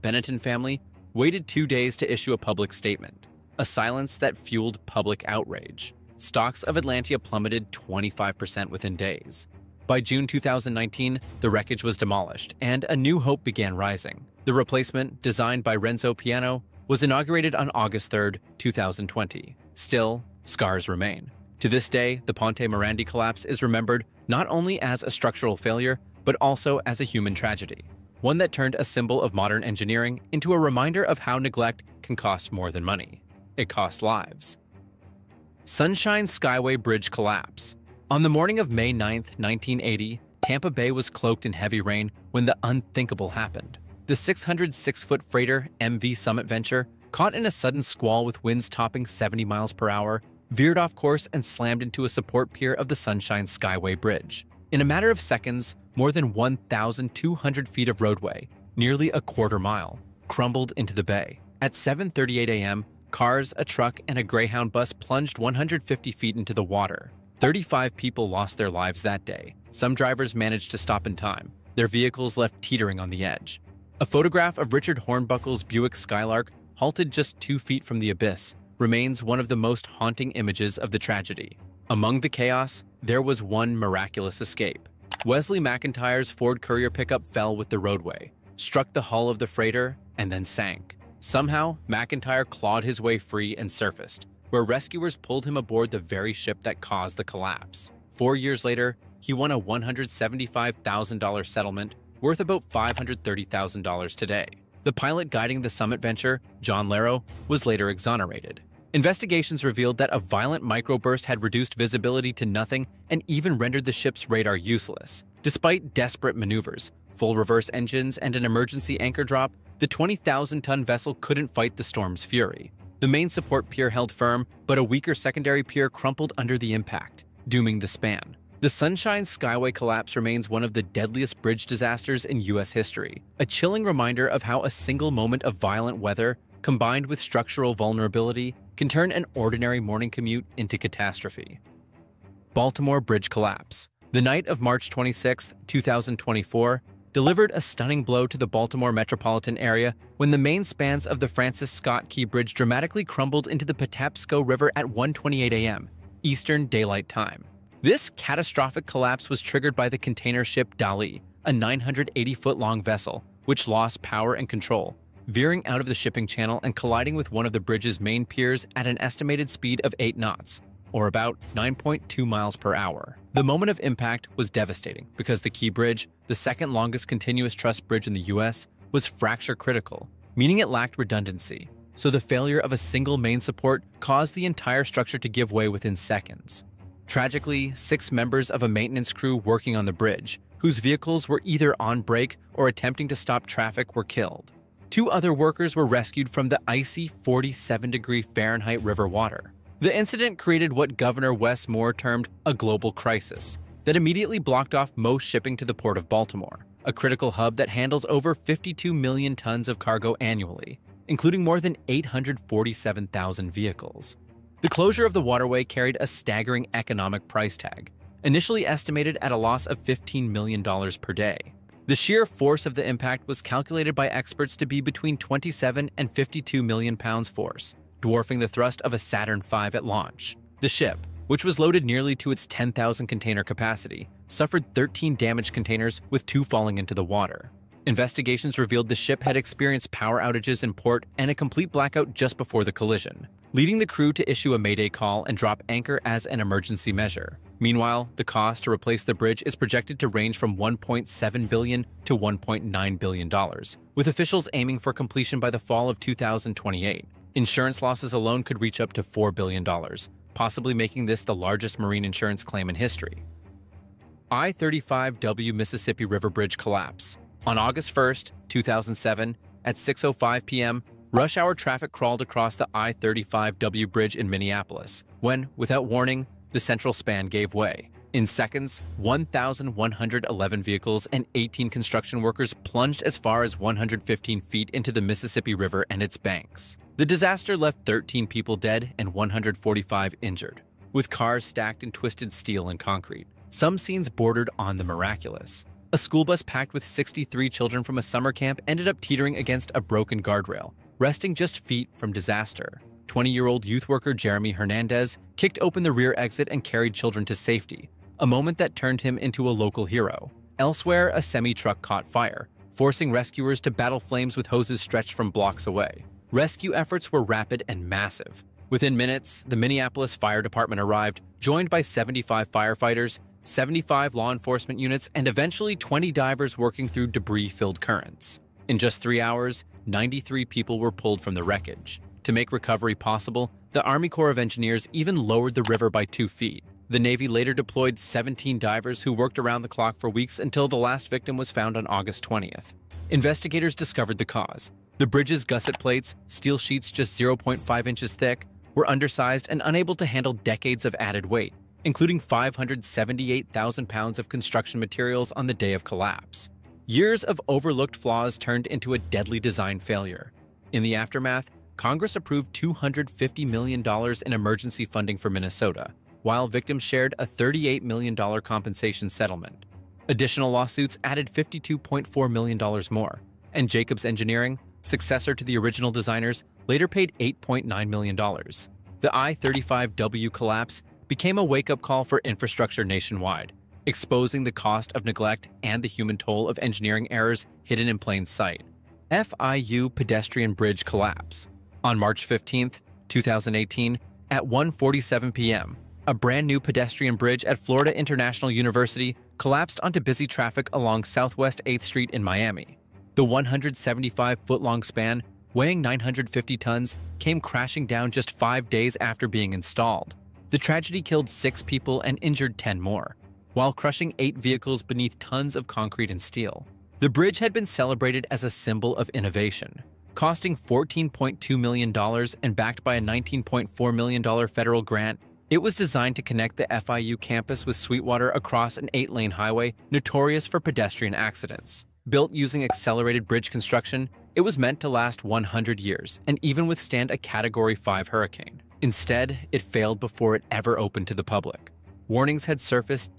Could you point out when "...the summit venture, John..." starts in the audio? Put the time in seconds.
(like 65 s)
105 s.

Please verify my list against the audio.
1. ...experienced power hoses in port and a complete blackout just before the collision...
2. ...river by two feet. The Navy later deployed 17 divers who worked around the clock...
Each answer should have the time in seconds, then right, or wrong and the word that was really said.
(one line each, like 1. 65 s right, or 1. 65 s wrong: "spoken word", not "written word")
1. 239 s wrong: "outages", not "hoses"
2. 335 s right.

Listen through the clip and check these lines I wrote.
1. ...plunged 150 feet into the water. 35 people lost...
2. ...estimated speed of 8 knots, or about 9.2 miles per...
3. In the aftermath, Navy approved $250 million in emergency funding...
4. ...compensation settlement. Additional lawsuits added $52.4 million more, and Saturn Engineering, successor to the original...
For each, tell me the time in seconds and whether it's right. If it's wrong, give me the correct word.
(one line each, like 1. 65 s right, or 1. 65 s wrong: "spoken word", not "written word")
1. 64 s right
2. 169 s right
3. 360 s wrong: "Congress", not "Navy"
4. 368 s wrong: "Jacobs", not "Saturn".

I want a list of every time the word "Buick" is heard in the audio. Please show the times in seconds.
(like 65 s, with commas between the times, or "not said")
75 s.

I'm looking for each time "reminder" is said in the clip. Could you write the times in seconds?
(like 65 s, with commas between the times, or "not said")
30 s, 133 s.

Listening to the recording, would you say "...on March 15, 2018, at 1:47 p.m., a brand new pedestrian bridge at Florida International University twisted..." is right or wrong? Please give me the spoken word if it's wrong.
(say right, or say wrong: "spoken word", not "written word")
wrong: "collapsed", not "twisted".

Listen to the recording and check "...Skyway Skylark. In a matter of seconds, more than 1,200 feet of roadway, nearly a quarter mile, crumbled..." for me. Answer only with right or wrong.
wrong.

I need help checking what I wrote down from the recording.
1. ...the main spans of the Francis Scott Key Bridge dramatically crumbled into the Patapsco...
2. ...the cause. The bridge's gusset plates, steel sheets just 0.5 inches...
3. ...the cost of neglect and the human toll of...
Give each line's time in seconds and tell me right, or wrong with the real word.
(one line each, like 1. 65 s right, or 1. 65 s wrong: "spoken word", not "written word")
1. 150 s right
2. 344 s right
3. 384 s right.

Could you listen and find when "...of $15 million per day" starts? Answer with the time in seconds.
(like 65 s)
219 s.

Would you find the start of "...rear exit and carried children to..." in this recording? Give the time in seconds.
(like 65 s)
305 s.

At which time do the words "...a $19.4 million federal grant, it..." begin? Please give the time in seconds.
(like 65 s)
422 s.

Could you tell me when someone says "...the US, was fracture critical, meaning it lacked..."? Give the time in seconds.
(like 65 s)
178 s.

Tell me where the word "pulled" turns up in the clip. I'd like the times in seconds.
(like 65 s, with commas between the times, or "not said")
95 s, 330 s.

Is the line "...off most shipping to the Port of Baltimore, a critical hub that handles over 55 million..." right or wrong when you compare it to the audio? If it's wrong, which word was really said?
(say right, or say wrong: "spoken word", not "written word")
wrong: "52", not "55".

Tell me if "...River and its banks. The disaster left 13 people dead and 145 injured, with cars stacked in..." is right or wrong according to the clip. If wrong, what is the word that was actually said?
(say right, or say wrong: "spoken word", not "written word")
right.